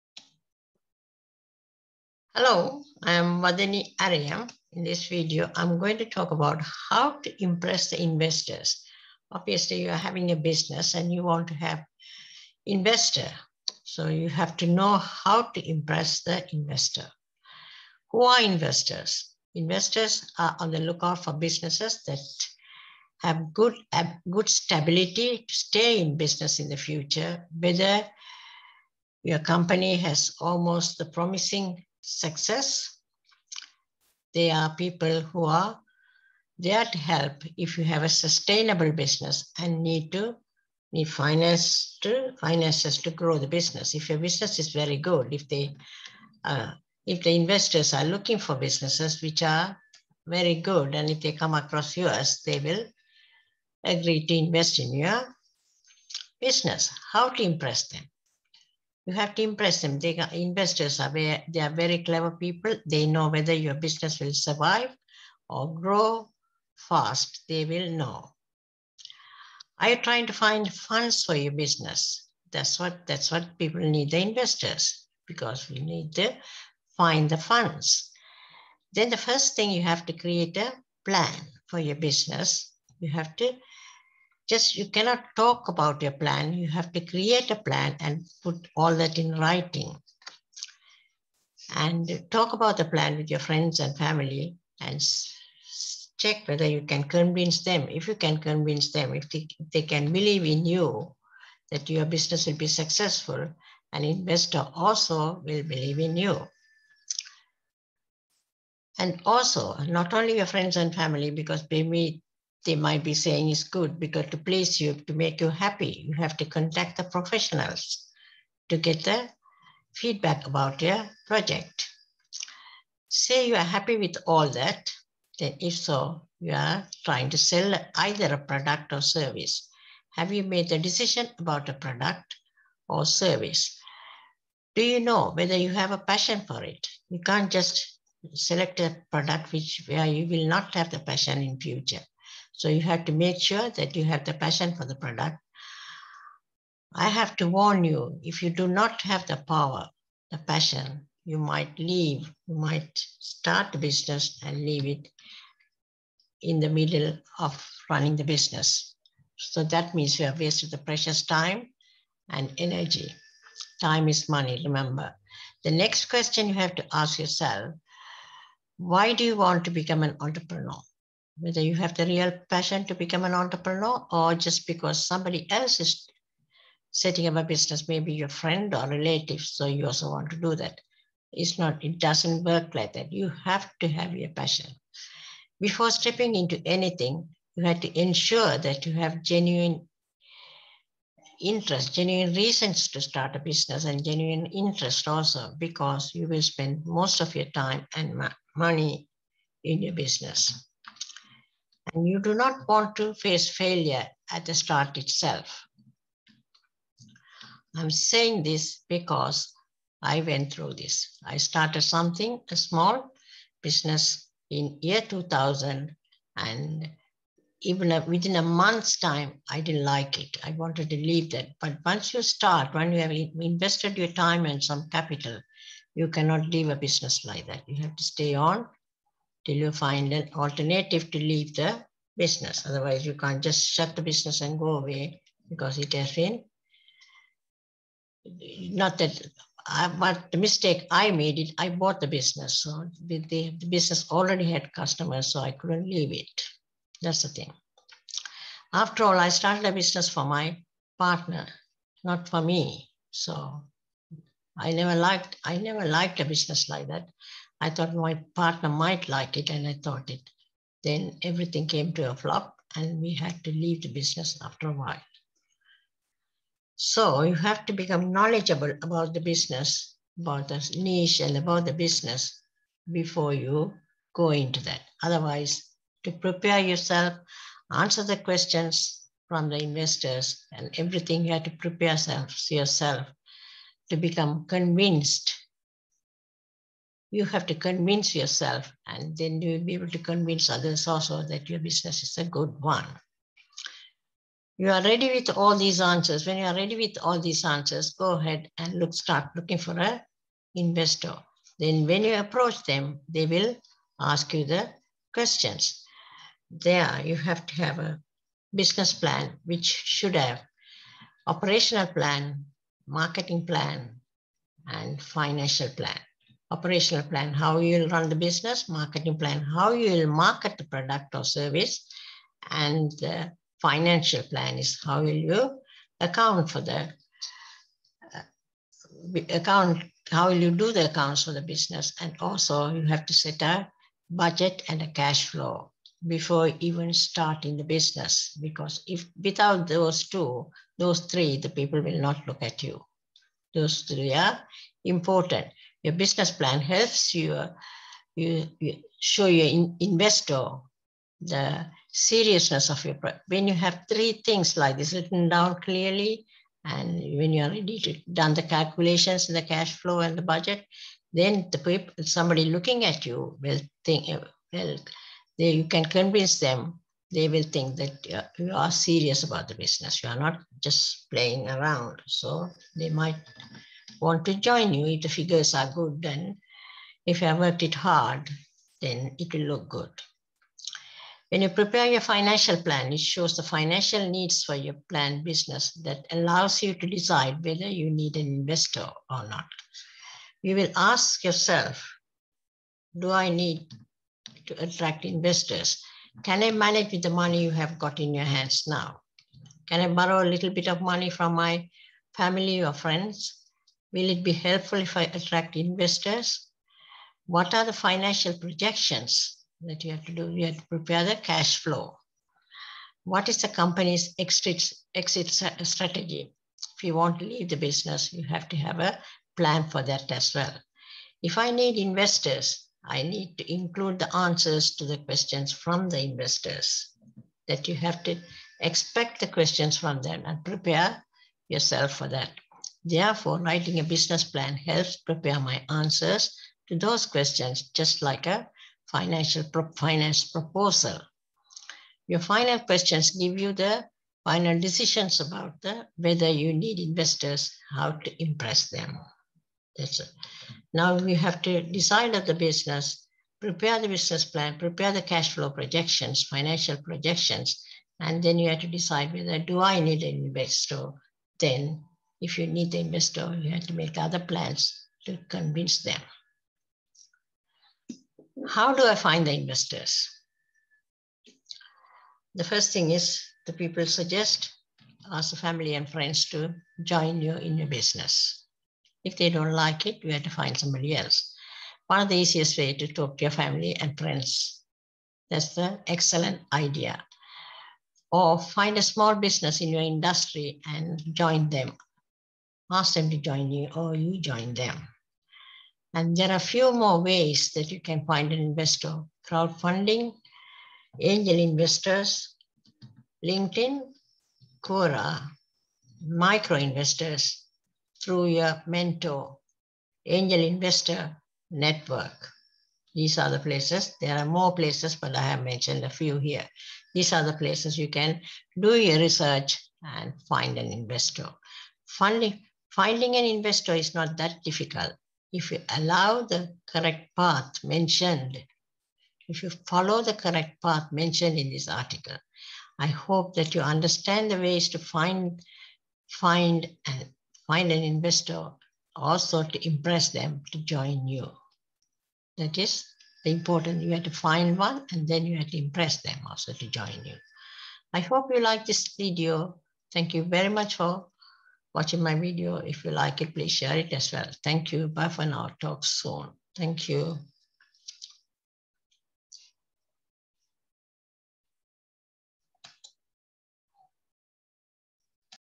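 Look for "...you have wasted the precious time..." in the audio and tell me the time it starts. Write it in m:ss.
2:40.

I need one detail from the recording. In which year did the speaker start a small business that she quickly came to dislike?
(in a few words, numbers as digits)
2000.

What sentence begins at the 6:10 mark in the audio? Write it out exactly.
You are not just playing around.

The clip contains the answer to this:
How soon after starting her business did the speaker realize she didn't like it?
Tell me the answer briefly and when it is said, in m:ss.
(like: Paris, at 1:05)
within a month, at 3:38.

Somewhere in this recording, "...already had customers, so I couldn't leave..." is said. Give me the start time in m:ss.
4:04.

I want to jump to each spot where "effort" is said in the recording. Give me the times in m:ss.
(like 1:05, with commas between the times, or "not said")
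not said.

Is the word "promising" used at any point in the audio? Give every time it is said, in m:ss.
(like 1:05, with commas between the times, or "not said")
0:31.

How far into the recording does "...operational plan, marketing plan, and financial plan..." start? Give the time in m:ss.
5:11.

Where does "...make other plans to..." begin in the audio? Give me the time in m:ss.
7:43.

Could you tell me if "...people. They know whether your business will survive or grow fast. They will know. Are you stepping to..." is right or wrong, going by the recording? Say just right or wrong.
wrong.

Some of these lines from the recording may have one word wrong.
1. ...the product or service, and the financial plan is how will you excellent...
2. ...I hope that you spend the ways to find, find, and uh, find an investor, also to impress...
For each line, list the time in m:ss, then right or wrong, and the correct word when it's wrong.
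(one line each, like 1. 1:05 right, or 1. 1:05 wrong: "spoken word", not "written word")
1. 5:20 wrong: "account", not "excellent"
2. 8:52 wrong: "understand", not "spend".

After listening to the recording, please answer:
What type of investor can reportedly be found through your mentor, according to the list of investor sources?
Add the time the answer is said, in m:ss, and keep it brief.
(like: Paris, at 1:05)
micro investors, at 8:26.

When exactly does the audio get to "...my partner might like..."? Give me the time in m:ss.
4:17.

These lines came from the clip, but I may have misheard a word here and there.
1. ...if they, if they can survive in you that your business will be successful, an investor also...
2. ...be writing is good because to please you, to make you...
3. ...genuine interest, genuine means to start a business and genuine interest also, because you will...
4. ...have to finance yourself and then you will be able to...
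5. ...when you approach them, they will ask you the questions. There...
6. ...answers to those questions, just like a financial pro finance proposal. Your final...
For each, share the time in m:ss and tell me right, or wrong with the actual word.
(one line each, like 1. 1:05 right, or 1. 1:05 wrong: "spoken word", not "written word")
1. 1:39 wrong: "believe", not "survive"
2. 1:53 wrong: "saying", not "writing"
3. 3:09 wrong: "reasons", not "means"
4. 4:47 wrong: "convince", not "finance"
5. 5:01 right
6. 7:15 right.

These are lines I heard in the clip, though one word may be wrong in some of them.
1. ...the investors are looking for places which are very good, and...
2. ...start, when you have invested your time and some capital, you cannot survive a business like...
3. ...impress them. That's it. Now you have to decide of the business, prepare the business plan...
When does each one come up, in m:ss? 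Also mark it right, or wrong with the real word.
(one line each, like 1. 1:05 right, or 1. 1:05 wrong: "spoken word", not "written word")
1. 0:47 wrong: "businesses", not "places"
2. 3:42 wrong: "leave", not "survive"
3. 7:28 right.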